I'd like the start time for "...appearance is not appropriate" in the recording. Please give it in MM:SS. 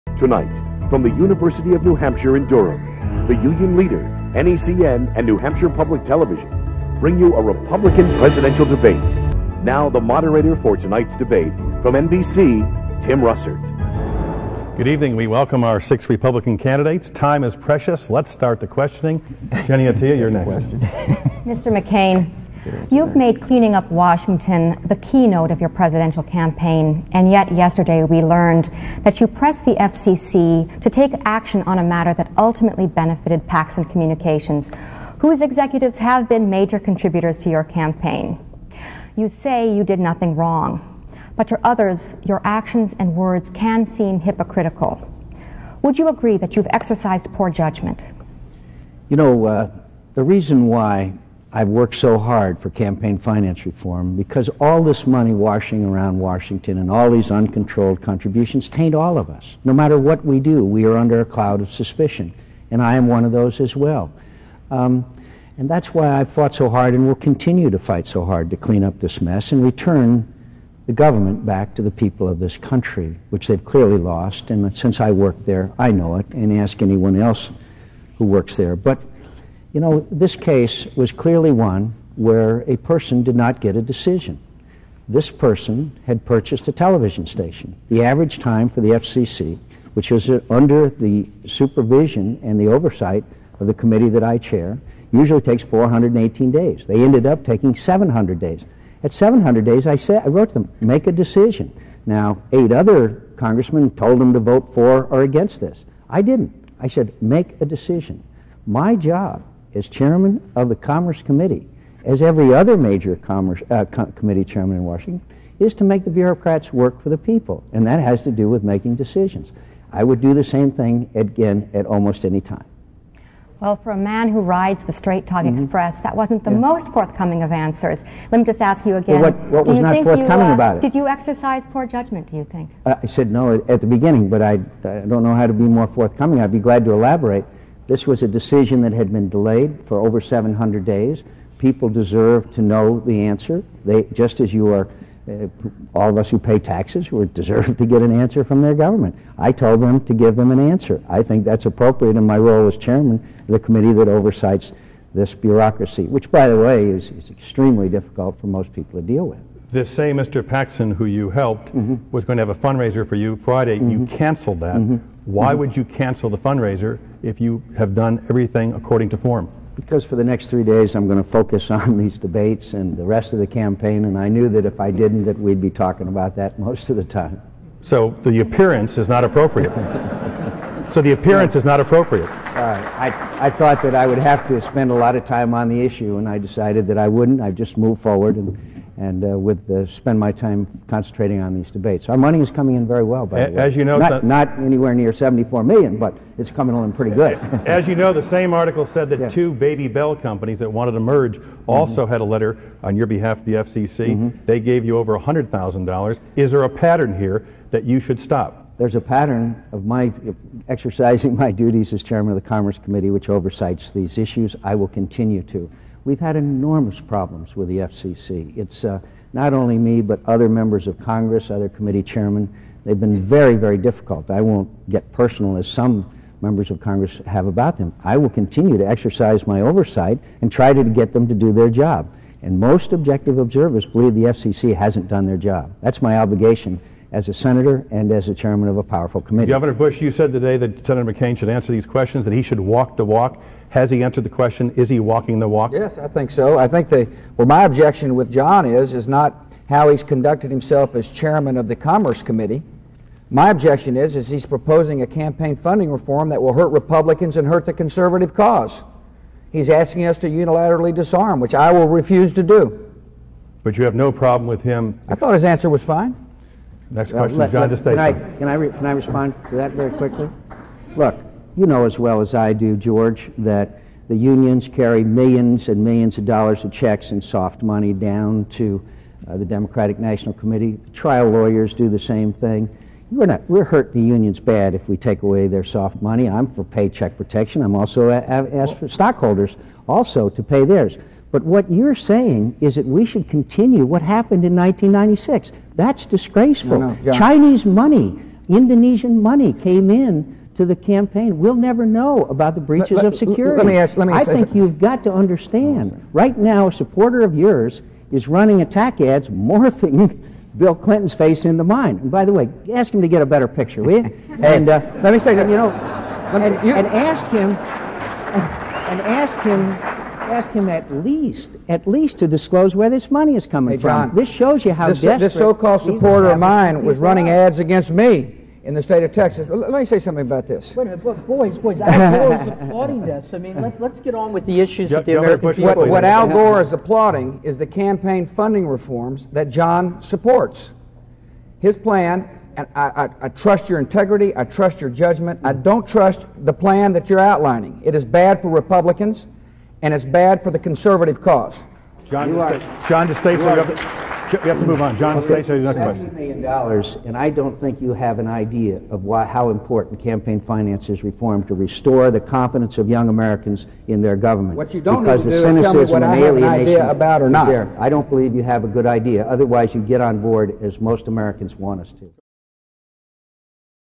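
02:58.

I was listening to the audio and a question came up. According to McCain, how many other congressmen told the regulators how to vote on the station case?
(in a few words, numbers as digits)
8.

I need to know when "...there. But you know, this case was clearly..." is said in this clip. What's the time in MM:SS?
01:18.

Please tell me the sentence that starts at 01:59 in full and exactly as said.
I would do the same thing again at almost any time.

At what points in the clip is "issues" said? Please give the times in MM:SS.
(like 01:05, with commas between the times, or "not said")
03:05, 03:34, 05:34.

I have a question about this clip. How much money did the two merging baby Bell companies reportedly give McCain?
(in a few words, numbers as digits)
over $100,000.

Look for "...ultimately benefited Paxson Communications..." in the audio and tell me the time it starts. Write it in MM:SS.
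00:32.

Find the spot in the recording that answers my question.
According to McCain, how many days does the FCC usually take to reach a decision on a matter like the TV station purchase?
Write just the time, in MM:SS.
01:35.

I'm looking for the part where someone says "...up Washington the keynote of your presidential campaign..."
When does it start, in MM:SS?
00:23.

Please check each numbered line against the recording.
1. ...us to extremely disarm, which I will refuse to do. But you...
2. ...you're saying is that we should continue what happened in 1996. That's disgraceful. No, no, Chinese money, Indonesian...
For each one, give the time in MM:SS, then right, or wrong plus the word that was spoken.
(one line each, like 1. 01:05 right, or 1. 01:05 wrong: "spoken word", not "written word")
1. 04:20 wrong: "unilaterally", not "extremely"
2. 04:51 right.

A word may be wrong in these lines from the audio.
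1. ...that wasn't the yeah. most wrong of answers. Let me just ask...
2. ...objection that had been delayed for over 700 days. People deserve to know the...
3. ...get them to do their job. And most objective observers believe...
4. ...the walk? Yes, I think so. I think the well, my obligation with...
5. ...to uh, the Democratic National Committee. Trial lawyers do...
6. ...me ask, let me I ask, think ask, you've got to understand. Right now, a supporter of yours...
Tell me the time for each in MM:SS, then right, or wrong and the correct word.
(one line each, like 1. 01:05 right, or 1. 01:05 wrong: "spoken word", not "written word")
1. 02:06 wrong: "forthcoming", not "wrong"
2. 02:18 wrong: "decision", not "objection"
3. 03:50 right
4. 04:05 wrong: "objection", not "obligation"
5. 04:38 right
6. 05:03 right.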